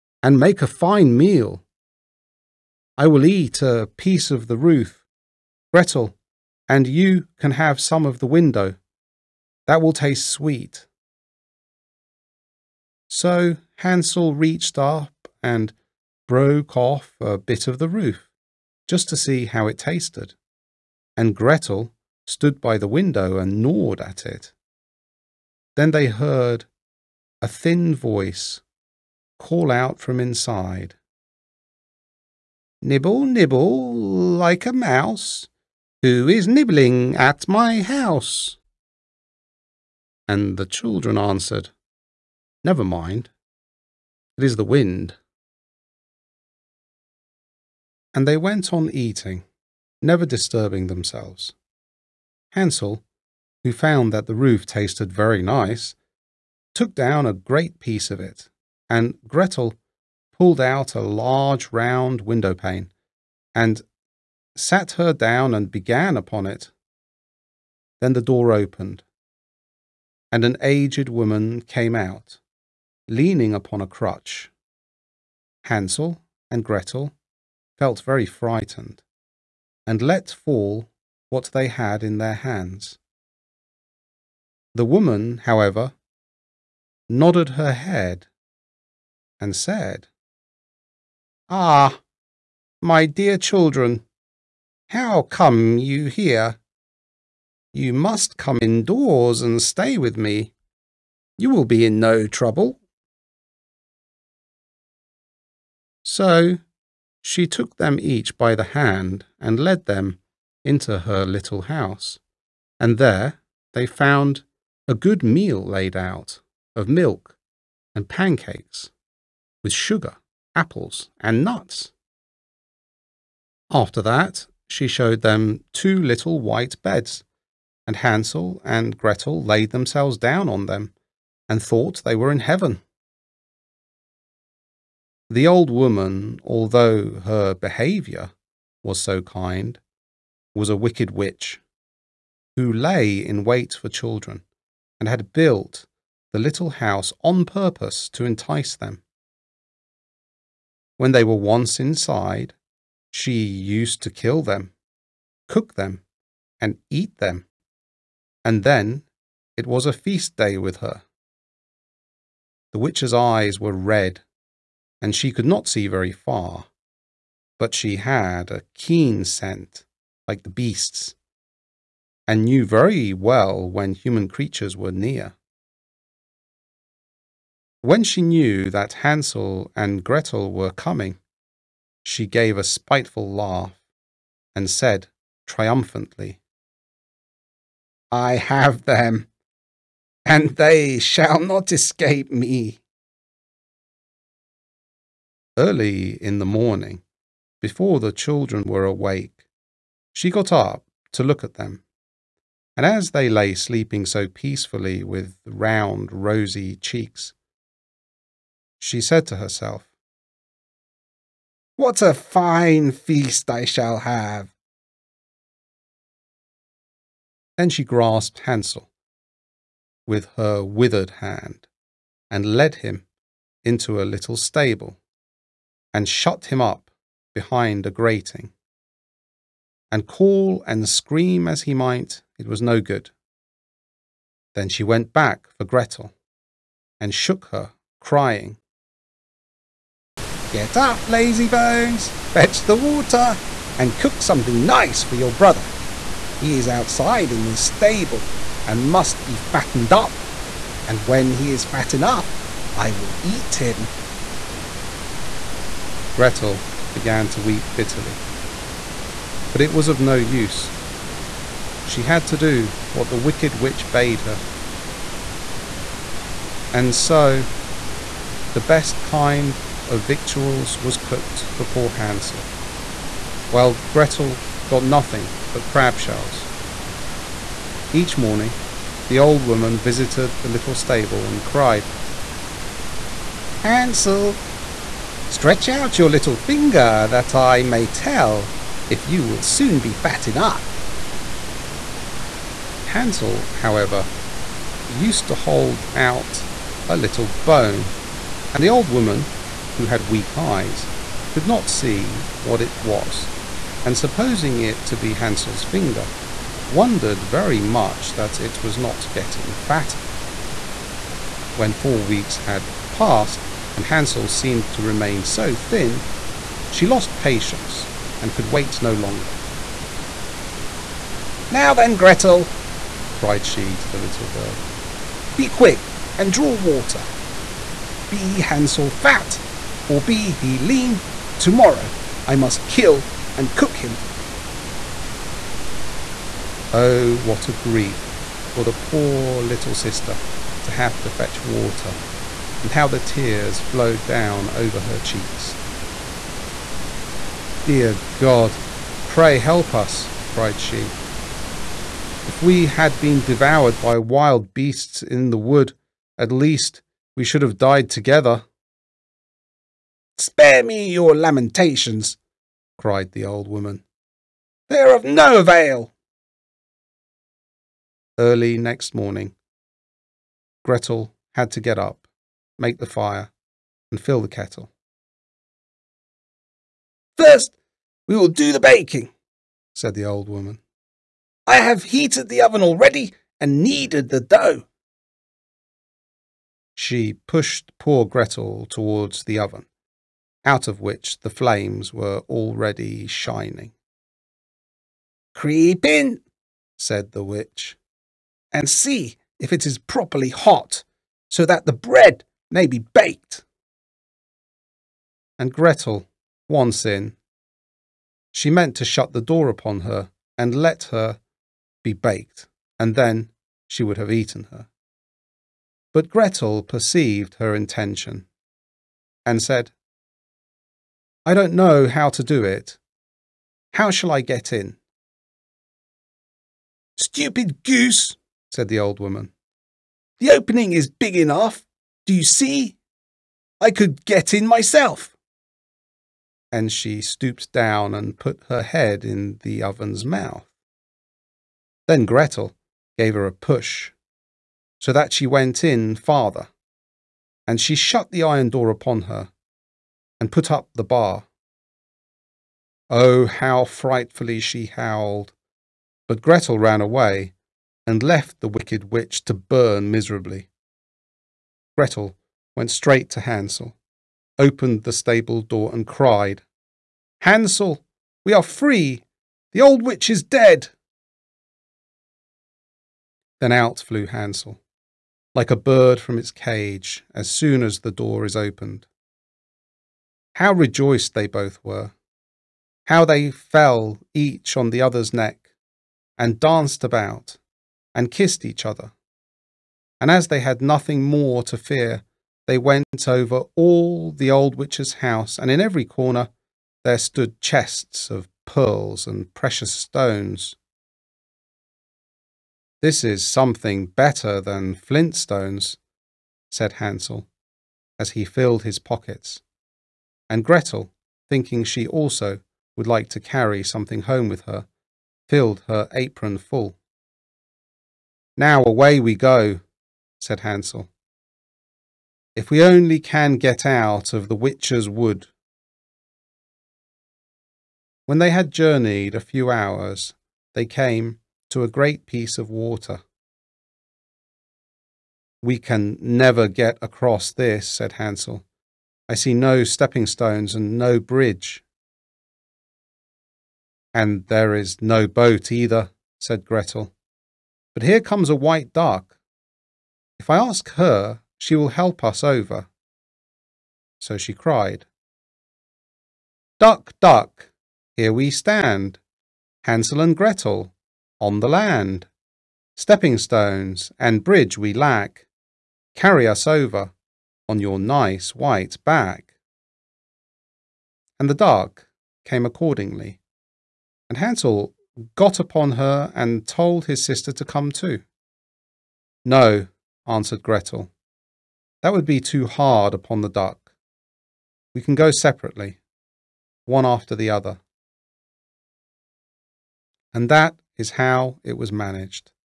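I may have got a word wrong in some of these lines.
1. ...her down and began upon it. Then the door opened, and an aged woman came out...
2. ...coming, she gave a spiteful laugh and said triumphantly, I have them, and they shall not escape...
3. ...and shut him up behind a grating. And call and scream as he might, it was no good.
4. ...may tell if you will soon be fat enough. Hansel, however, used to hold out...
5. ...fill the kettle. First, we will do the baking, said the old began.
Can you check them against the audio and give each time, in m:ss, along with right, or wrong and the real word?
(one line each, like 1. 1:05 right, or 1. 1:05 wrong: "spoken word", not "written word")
1. 1:05 right
2. 3:00 right
3. 3:45 right
4. 4:47 right
5. 6:13 wrong: "woman", not "began".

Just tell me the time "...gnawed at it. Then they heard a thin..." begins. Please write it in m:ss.
0:23.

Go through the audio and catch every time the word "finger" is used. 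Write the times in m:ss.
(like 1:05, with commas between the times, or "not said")
4:46, 5:05.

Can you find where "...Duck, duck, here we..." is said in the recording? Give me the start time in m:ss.
9:16.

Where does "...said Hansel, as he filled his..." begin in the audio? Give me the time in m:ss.
8:26.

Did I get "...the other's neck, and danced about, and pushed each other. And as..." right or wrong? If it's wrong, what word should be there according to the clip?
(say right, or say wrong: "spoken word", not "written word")
wrong: "kissed", not "pushed".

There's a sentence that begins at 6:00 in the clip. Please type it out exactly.
Spare me your lamentations, cried the old woman.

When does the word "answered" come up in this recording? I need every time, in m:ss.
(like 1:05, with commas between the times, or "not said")
0:41, 9:40.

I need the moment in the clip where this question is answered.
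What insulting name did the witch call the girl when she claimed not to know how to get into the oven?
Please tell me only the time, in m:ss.
7:06.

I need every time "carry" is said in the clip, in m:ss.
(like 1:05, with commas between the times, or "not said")
8:33, 9:25.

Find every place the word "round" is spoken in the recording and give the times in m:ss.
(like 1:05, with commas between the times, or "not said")
1:01, 3:25.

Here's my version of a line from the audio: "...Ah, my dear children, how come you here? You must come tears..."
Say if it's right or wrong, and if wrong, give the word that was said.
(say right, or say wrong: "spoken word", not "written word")
wrong: "indoors", not "tears".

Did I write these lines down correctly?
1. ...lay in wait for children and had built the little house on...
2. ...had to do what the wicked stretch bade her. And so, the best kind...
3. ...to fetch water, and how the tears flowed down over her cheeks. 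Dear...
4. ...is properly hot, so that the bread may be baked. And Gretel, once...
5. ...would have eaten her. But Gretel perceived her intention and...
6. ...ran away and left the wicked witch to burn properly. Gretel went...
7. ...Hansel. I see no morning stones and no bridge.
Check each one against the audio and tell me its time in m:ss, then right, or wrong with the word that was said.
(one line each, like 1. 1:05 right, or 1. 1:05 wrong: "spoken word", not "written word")
1. 2:22 right
2. 4:22 wrong: "witch", not "stretch"
3. 5:41 right
4. 6:39 right
5. 6:53 right
6. 7:36 wrong: "miserably", not "properly"
7. 8:57 wrong: "stepping", not "morning".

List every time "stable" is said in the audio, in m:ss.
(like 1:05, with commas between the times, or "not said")
3:44, 4:07, 4:40, 7:44.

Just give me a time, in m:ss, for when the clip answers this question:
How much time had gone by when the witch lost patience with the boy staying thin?
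5:11.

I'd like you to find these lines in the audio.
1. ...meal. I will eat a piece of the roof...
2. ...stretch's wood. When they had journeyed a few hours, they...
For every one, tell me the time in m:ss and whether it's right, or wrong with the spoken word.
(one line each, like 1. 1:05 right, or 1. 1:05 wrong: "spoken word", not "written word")
1. 0:01 right
2. 8:44 wrong: "witch", not "stretch".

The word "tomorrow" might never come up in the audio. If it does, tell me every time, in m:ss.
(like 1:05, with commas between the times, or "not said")
5:31.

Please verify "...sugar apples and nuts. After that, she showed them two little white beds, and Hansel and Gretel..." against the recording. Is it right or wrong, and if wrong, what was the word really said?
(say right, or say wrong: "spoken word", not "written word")
right.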